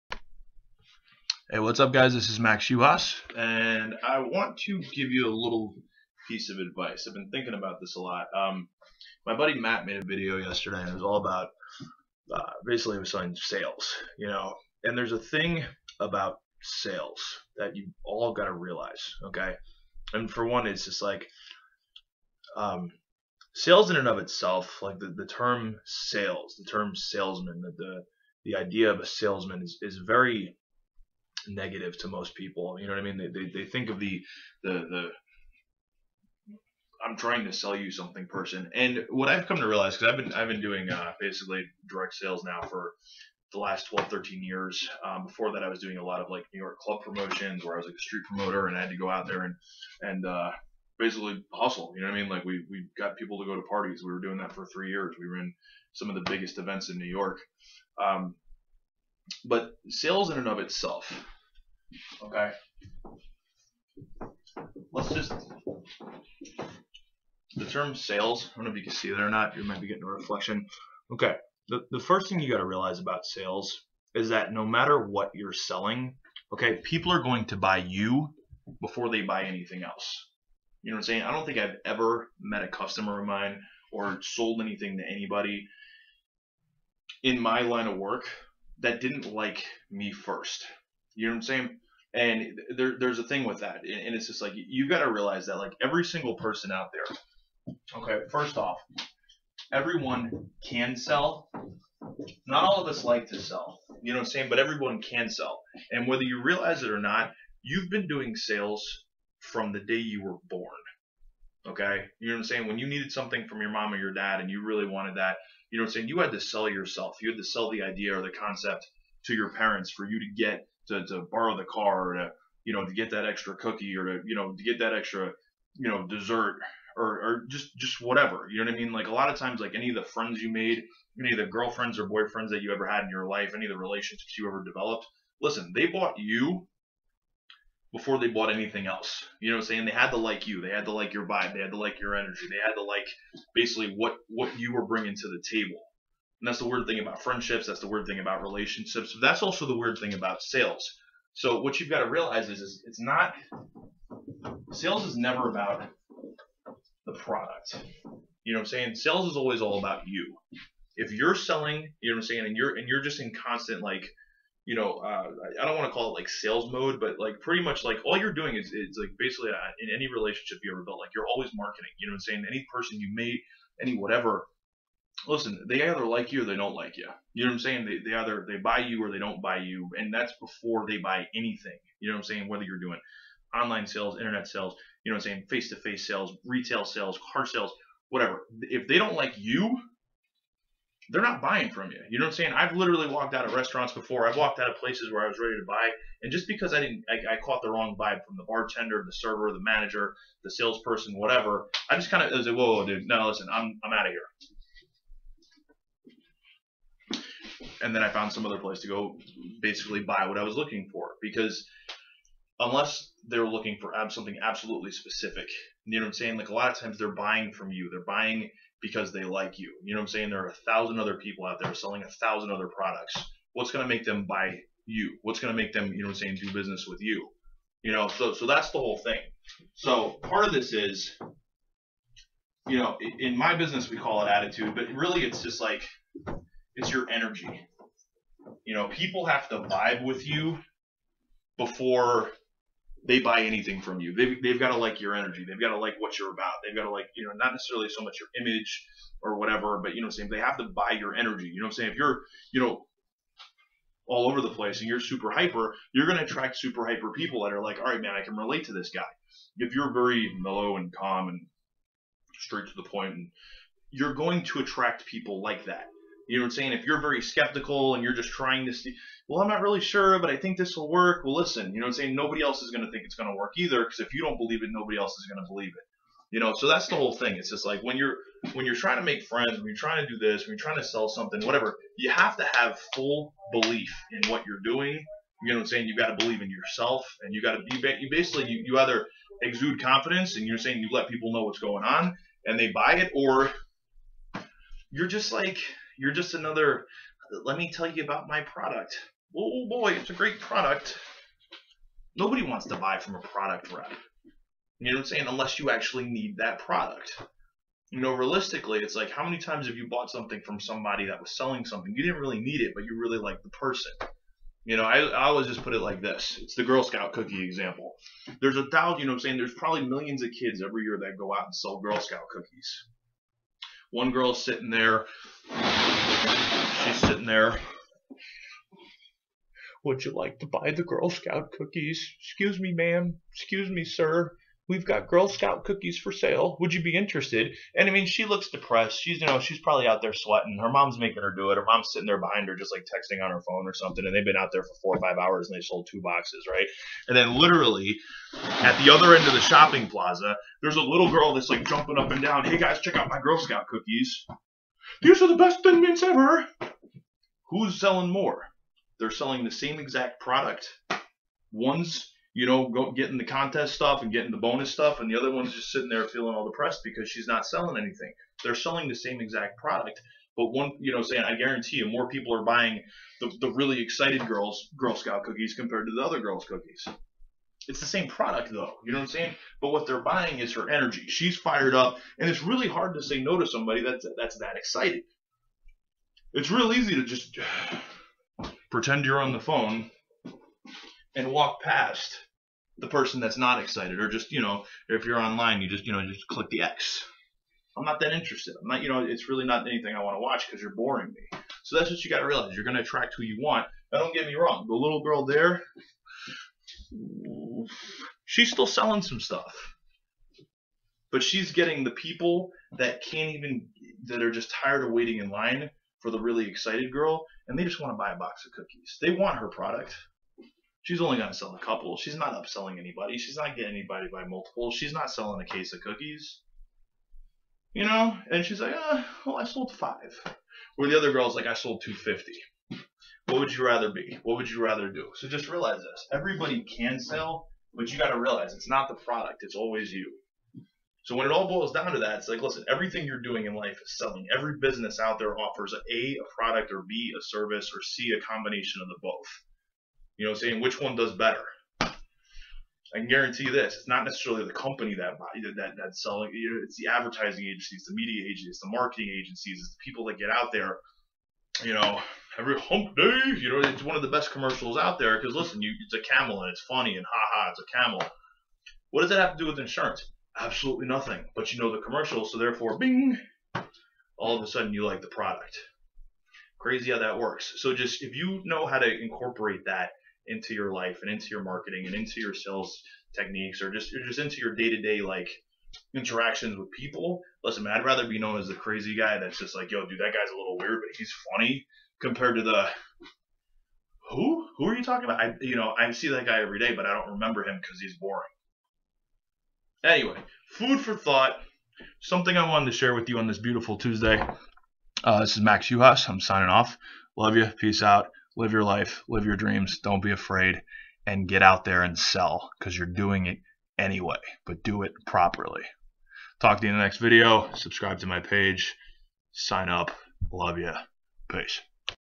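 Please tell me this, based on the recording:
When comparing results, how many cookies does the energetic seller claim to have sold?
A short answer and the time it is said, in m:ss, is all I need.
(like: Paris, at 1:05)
250, at 7:11.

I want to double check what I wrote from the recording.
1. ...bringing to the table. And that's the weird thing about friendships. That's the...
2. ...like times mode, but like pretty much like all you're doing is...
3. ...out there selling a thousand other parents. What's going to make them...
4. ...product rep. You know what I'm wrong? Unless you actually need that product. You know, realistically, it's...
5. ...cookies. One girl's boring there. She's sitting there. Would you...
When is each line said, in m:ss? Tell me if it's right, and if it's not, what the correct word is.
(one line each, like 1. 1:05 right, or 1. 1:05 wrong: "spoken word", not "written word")
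1. 2:24 right
2. 2:46 wrong: "sales", not "times"
3. 3:41 wrong: "products", not "parents"
4. 5:03 wrong: "saying", not "wrong"
5. 5:22 wrong: "sitting", not "boring".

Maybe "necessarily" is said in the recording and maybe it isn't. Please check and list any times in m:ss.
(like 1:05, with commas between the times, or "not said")
4:07, 7:34.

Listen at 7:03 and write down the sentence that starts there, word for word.
She's not getting anybody by multiple.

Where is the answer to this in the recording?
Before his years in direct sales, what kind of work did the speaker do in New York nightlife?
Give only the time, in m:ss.
0:46.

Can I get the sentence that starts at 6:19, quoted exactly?
But what they're buying is her energy.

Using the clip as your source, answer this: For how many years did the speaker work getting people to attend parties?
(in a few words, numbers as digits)
3.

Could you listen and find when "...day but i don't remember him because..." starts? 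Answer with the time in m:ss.
8:16.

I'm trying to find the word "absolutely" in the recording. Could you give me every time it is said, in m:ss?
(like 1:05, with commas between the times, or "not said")
3:34, 7:50.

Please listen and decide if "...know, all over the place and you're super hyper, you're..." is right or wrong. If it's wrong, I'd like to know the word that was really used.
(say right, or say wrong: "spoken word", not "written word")
right.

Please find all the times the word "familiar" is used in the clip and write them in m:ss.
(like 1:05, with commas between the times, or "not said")
not said.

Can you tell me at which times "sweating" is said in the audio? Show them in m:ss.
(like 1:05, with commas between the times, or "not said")
5:40.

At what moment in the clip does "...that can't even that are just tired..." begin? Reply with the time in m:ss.
6:52.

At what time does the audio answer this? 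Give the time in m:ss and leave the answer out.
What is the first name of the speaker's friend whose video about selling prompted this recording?
0:09.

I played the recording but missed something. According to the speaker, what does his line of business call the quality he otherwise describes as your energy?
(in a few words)
attitude.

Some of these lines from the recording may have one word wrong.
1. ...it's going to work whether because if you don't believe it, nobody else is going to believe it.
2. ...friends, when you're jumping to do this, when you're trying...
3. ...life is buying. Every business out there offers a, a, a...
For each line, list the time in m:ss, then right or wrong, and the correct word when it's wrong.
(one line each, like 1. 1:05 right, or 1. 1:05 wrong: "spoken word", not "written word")
1. 4:33 wrong: "either", not "whether"
2. 4:39 wrong: "trying", not "jumping"
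3. 7:23 wrong: "selling", not "buying".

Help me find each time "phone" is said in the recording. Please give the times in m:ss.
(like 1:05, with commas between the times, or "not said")
5:43, 6:29.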